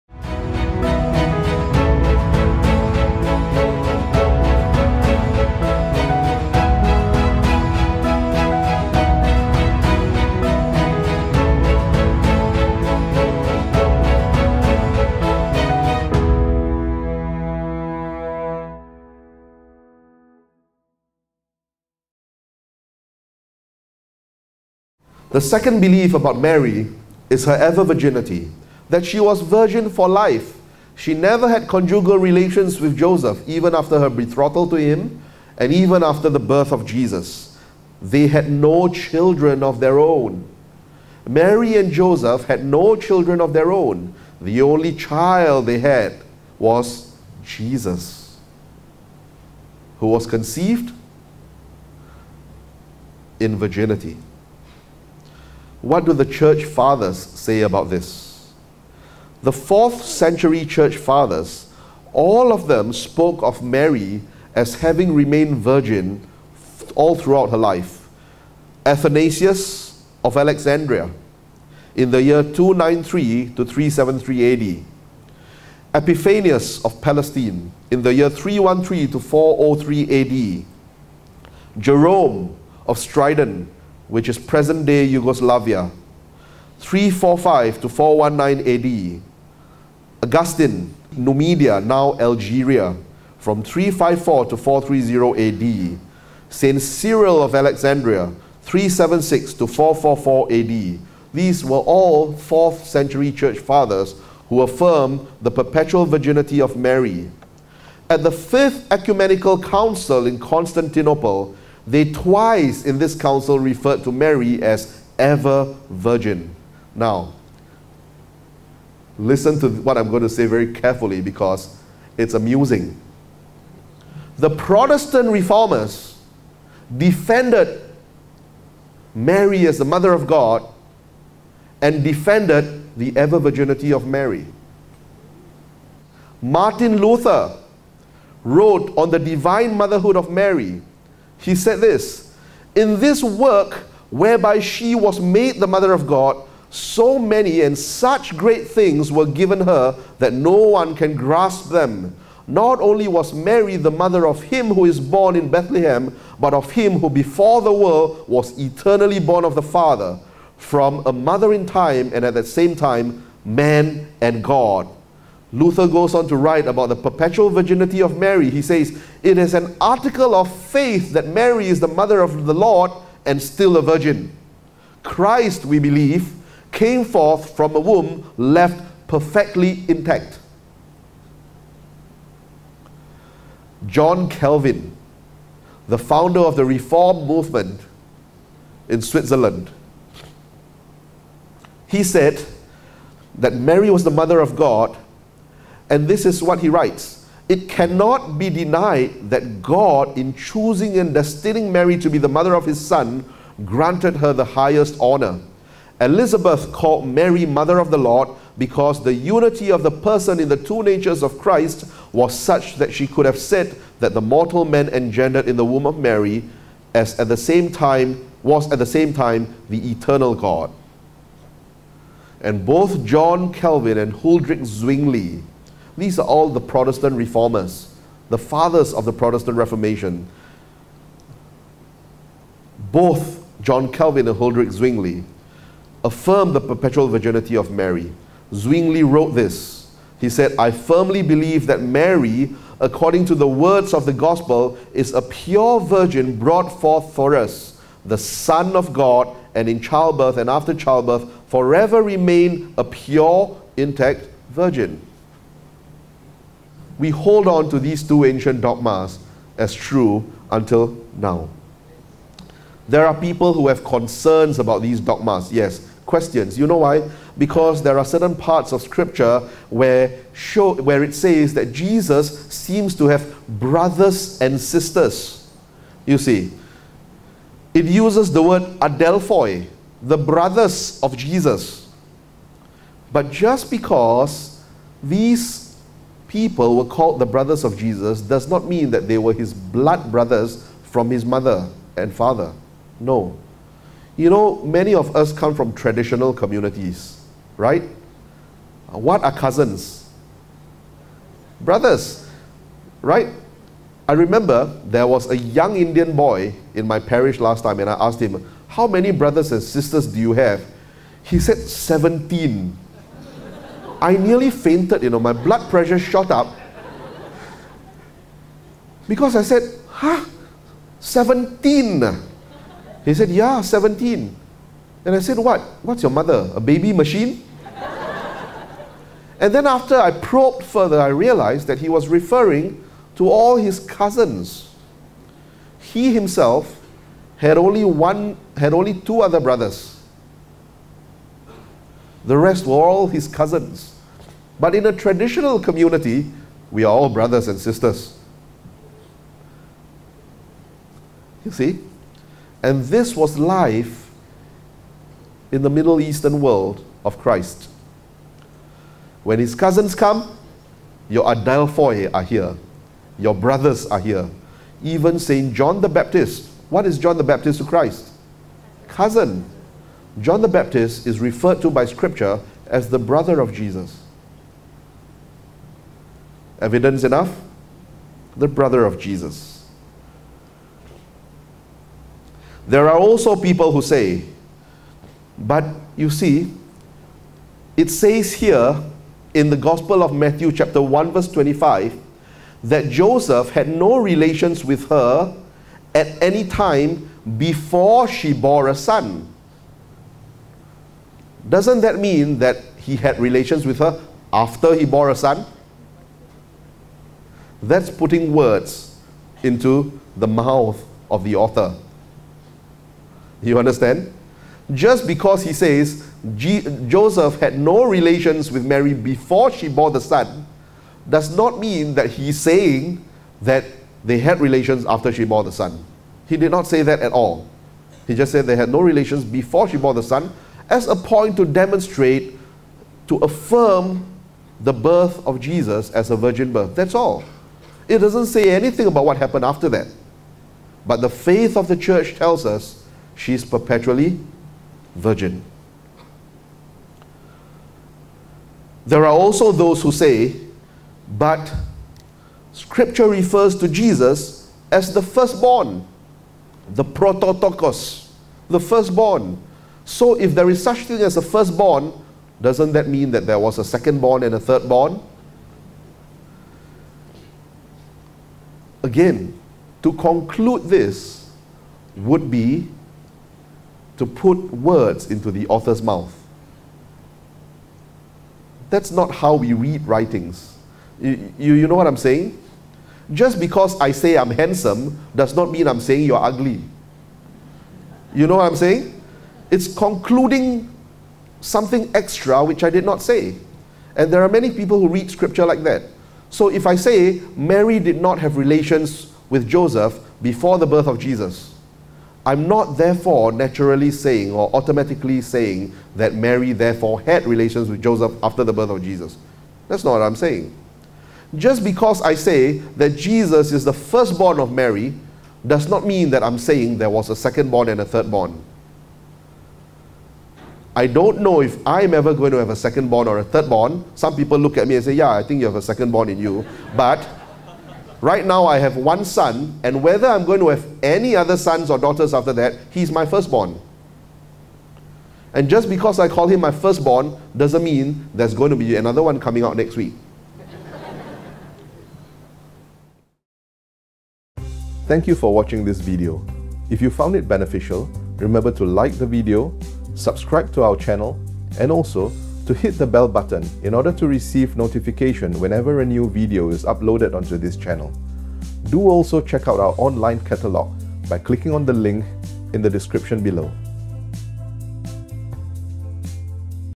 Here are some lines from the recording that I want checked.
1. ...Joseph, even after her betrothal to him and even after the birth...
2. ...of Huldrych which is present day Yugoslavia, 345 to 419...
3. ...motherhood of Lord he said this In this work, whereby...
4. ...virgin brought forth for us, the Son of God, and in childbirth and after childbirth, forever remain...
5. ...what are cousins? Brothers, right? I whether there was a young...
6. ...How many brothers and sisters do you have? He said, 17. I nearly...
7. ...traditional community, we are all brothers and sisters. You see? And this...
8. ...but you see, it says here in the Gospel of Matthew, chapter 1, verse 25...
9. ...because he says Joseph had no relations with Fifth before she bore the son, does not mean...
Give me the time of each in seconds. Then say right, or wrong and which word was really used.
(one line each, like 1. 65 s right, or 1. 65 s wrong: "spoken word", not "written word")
1. 32 s right
2. 82 s wrong: "Stridon", not "Huldrych"
3. 139 s wrong: "Mary", not "Lord"
4. 245 s right
5. 298 s wrong: "remember", not "whether"
6. 308 s right
7. 344 s right
8. 385 s right
9. 415 s wrong: "Mary", not "Fifth".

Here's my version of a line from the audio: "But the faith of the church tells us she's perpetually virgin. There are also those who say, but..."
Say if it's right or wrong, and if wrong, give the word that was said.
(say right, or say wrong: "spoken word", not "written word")
right.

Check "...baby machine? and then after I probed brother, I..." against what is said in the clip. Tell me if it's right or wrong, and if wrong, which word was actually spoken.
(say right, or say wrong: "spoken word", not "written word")
wrong: "further", not "brother".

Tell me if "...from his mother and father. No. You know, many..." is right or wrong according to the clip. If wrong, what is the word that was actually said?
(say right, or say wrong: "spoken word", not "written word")
right.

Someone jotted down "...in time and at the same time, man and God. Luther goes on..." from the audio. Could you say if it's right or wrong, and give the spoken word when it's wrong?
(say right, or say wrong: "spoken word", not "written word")
right.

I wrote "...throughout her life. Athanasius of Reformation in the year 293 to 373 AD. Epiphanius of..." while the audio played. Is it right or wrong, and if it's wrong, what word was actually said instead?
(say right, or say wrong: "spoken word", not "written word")
wrong: "Alexandria", not "Reformation".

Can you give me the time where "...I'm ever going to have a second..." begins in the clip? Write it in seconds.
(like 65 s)
521 s.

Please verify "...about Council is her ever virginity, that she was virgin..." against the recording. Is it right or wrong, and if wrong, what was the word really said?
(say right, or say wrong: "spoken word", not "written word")
wrong: "Mary", not "Council".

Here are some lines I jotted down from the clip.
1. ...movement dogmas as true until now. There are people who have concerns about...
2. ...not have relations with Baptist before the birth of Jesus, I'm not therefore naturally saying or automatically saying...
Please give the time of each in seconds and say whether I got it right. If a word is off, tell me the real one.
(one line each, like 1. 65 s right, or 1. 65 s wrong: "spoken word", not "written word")
1. 258 s wrong: "ancient", not "movement"
2. 498 s wrong: "Joseph", not "Baptist".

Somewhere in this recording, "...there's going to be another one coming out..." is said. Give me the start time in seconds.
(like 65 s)
538 s.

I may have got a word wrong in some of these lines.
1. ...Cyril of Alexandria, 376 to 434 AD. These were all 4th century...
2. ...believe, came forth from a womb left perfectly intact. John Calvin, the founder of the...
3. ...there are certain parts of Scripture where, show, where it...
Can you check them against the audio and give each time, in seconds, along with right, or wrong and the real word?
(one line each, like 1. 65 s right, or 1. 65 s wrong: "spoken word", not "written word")
1. 96 s wrong: "444", not "434"
2. 175 s right
3. 267 s right.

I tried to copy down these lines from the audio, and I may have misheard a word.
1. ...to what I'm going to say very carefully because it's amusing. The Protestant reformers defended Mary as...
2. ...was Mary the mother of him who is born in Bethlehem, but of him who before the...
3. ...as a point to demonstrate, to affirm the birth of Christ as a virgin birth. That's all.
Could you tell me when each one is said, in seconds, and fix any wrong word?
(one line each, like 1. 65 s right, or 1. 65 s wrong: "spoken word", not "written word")
1. 119 s right
2. 153 s right
3. 430 s wrong: "Jesus", not "Christ".